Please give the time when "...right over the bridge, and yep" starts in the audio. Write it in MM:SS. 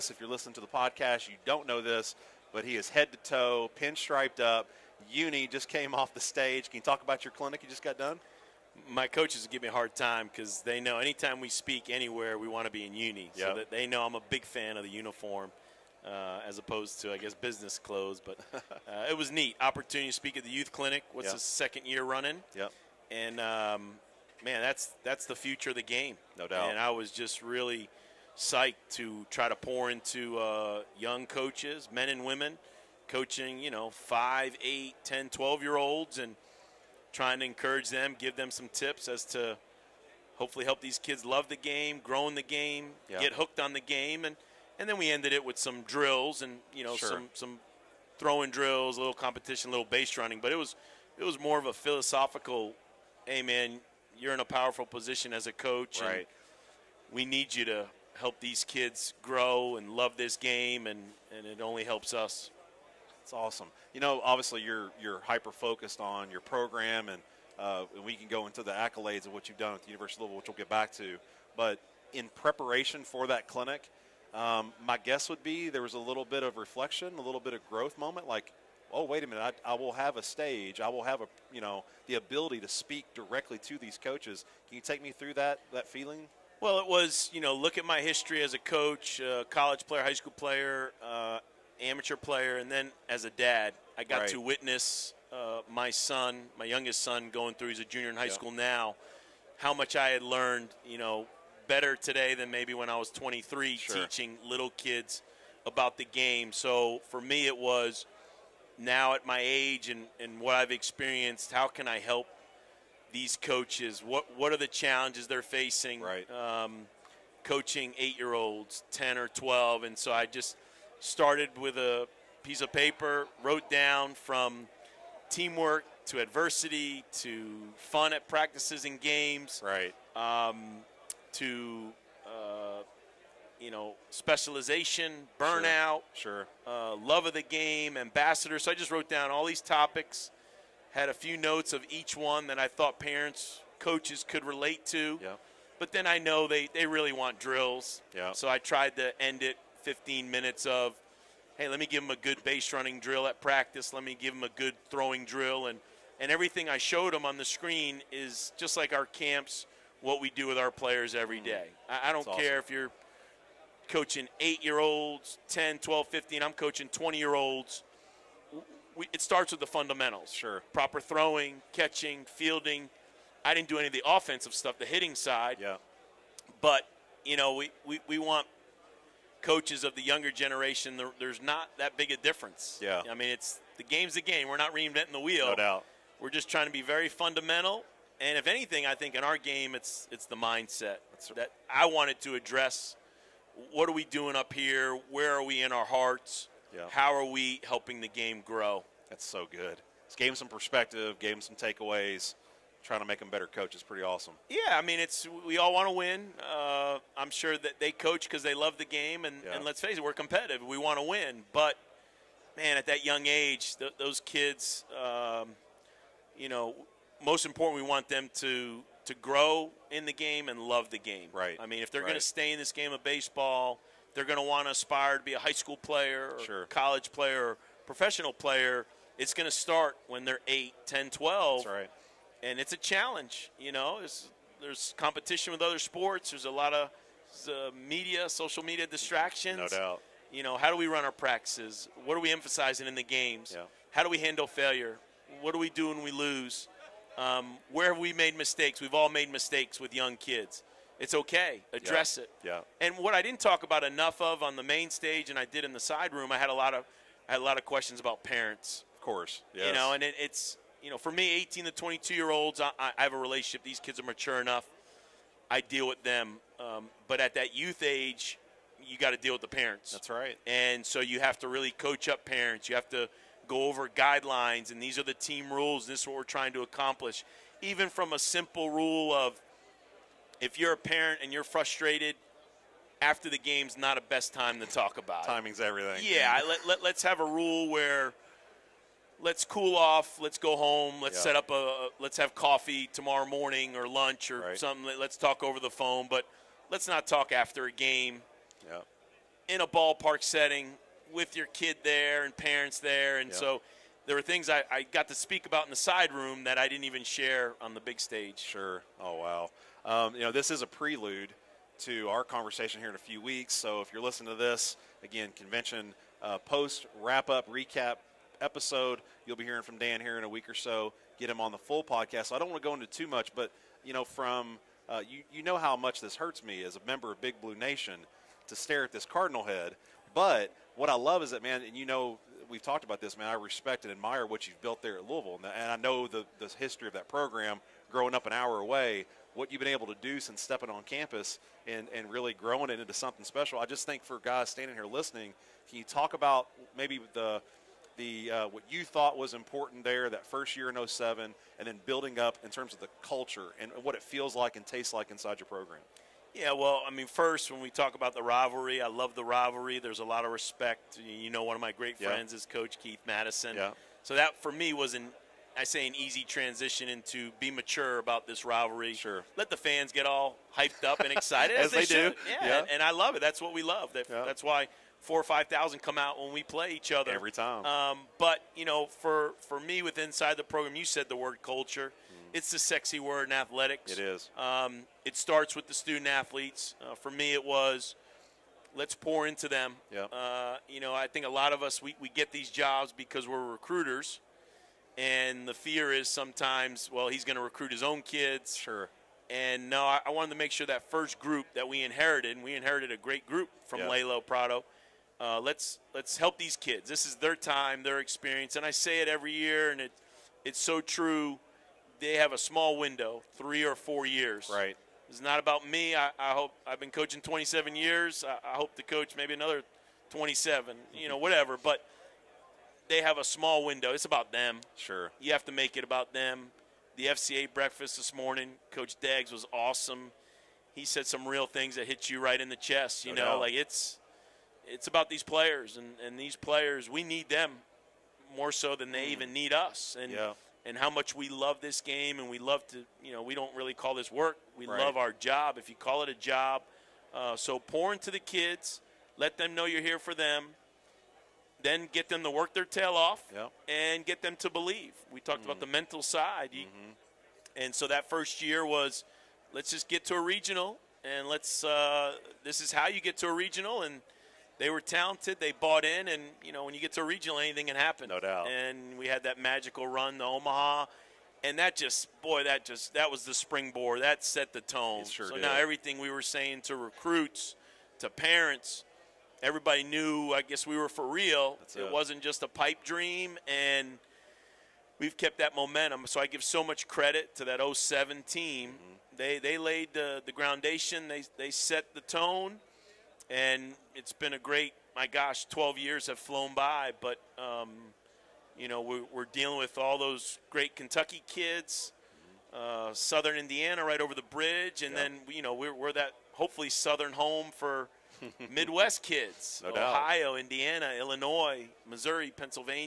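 08:23.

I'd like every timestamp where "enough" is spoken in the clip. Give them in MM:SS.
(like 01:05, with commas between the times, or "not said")
04:13, 04:24.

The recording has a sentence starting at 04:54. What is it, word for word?
Let's talk over the phone, but let's not talk after a game.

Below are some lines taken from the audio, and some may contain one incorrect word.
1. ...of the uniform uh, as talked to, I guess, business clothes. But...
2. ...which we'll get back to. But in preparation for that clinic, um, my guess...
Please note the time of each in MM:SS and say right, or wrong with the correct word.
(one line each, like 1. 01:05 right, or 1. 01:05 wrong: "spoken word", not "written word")
1. 00:14 wrong: "opposed", not "talked"
2. 01:10 right.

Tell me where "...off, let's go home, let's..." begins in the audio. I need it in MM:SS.
04:49.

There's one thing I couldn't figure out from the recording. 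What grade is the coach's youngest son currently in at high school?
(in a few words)
Junior.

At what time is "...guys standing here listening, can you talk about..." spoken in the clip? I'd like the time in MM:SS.
05:44.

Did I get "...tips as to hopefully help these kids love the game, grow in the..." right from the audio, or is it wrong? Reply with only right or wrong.
right.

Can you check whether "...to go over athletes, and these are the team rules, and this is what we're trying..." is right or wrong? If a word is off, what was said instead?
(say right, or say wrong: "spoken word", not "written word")
wrong: "guidelines", not "athletes".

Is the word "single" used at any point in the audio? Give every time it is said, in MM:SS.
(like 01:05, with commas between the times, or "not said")
not said.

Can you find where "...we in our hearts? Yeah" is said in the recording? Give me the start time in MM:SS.
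03:15.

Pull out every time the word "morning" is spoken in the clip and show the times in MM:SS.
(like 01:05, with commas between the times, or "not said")
04:53, 07:08.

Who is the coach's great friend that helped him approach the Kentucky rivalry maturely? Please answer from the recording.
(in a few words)
Keith Madison.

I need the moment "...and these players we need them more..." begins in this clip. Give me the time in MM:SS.
07:16.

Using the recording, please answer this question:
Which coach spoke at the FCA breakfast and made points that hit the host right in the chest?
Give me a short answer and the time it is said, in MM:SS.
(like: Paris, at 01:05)
Coach Deggs, at 07:08.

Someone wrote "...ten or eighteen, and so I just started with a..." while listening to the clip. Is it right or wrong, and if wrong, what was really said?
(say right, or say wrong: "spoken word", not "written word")
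wrong: "twelve", not "eighteen".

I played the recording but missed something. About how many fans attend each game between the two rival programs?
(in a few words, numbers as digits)
4,000 or 5,000.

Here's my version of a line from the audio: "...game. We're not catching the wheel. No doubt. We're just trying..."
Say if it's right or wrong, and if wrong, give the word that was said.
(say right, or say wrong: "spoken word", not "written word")
wrong: "reinventing", not "catching".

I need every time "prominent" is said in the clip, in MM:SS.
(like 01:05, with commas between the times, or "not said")
not said.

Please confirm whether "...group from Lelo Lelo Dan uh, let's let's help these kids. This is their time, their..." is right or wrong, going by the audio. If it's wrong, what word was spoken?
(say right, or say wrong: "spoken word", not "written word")
wrong: "Prado", not "Dan".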